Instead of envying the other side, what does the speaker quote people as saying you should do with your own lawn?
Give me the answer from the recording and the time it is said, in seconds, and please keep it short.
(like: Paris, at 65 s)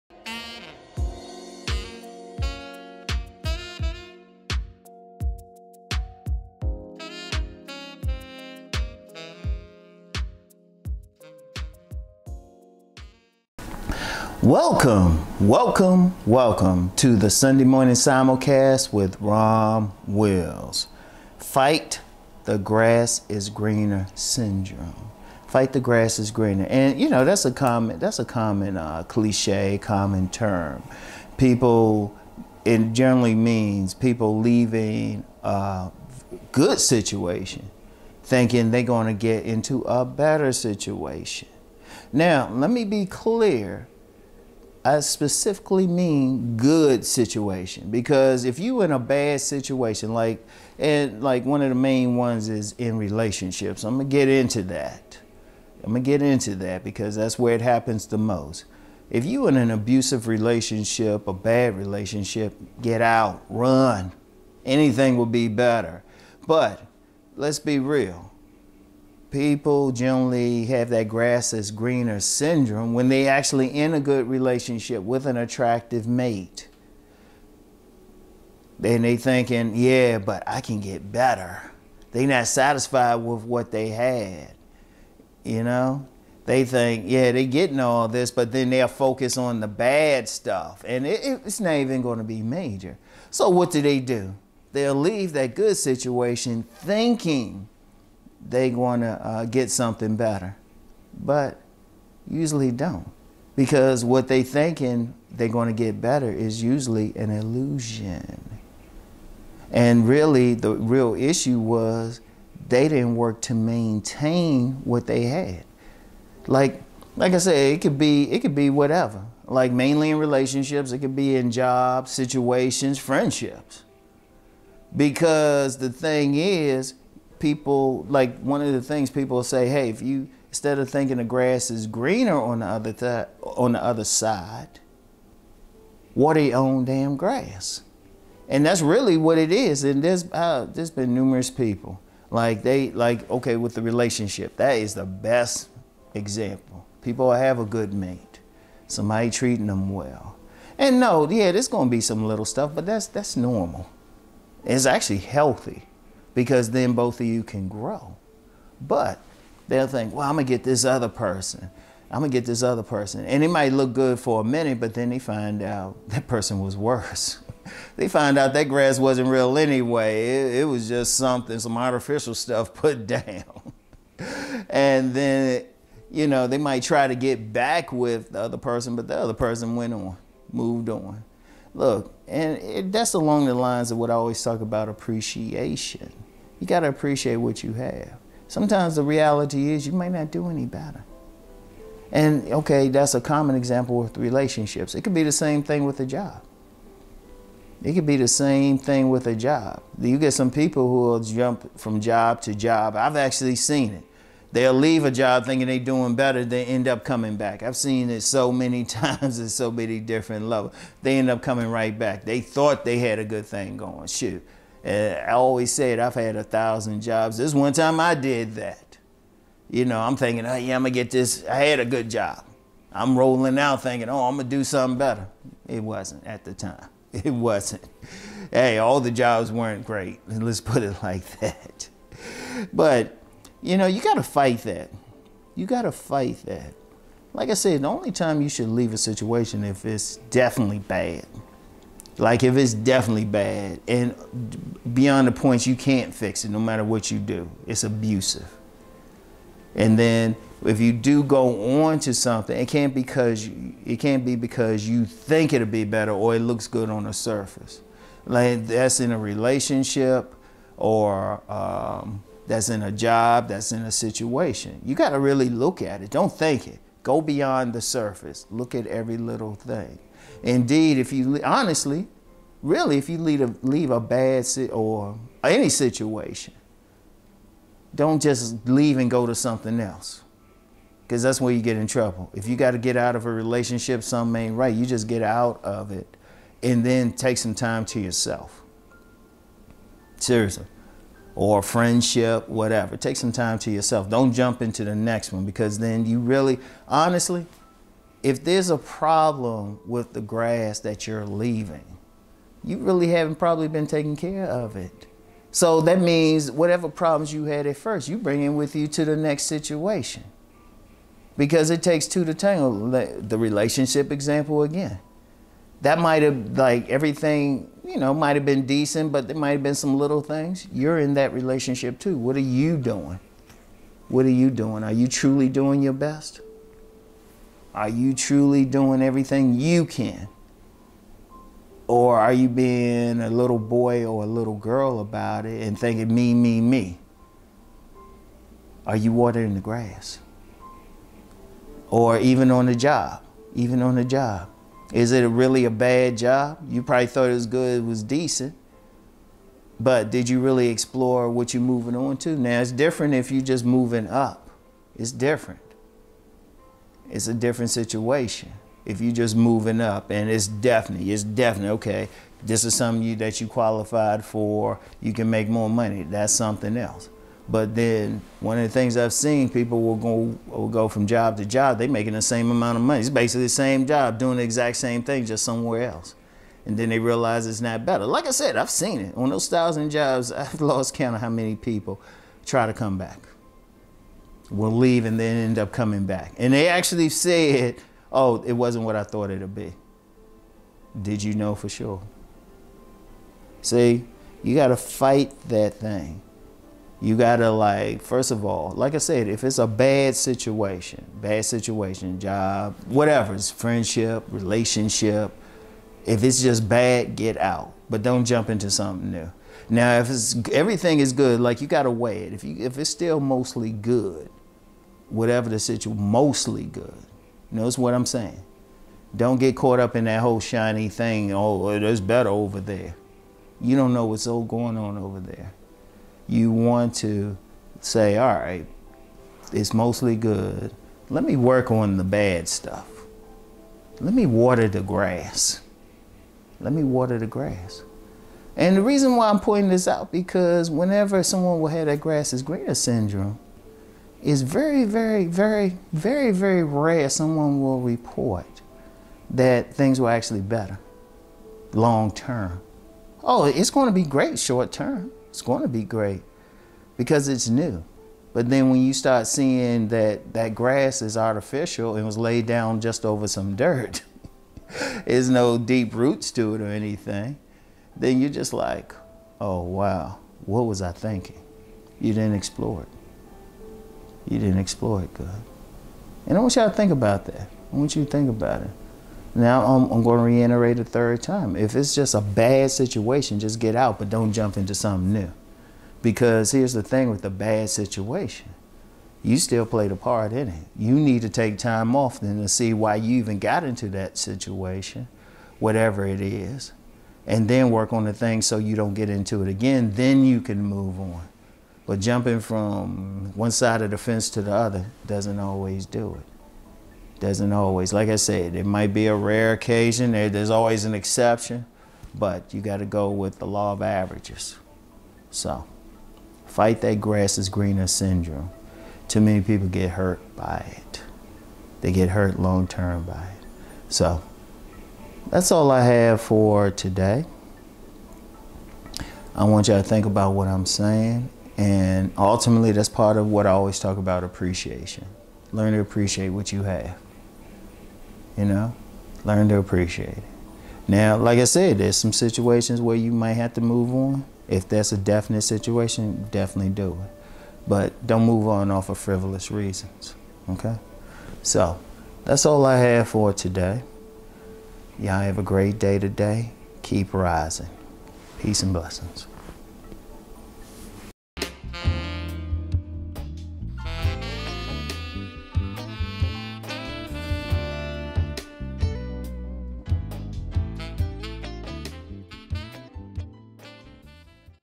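water your own damn grass, at 136 s.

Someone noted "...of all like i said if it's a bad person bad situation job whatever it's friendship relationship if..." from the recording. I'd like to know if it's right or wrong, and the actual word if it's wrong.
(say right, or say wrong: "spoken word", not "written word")
wrong: "situation", not "person".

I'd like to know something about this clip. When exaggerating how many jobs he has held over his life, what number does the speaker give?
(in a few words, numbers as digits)
1000.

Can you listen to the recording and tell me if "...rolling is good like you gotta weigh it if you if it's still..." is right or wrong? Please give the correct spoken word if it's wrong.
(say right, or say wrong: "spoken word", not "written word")
wrong: "everything", not "rolling".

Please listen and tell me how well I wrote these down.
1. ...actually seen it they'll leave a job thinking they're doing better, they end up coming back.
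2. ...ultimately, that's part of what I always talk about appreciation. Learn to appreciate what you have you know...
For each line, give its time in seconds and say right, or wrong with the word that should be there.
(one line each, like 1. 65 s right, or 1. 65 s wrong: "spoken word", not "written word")
1. 203 s right
2. 532 s right.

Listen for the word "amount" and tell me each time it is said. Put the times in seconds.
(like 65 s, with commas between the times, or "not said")
372 s.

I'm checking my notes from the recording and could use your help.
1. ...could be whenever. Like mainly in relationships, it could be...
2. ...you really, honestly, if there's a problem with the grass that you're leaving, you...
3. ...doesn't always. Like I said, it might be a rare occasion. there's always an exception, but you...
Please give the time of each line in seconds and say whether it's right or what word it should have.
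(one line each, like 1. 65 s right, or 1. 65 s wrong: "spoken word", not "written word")
1. 118 s wrong: "whatever", not "whenever"
2. 296 s right
3. 507 s right.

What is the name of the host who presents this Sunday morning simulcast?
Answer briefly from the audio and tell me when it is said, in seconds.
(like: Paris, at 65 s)
Rom Wills, at 19 s.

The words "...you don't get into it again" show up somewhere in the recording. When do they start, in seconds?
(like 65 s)
498 s.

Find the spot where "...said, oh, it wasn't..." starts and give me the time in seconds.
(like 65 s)
387 s.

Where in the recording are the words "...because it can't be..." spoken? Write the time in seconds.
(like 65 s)
252 s.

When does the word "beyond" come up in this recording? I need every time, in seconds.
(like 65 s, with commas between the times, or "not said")
244 s, 267 s.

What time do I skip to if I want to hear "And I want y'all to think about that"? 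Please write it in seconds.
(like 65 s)
476 s.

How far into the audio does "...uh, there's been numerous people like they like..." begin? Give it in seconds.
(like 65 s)
140 s.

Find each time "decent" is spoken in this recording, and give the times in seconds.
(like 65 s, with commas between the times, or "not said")
318 s, 348 s.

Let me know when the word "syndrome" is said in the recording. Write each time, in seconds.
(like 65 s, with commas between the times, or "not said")
24 s, 72 s, 442 s, 517 s.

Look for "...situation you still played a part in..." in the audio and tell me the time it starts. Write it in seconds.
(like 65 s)
487 s.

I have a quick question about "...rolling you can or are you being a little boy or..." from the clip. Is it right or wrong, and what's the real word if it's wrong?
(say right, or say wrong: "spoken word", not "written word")
wrong: "everything", not "rolling".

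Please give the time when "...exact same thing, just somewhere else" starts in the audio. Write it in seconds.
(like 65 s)
374 s.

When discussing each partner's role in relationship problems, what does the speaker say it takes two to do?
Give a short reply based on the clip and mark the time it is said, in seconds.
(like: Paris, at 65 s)
tangle, at 312 s.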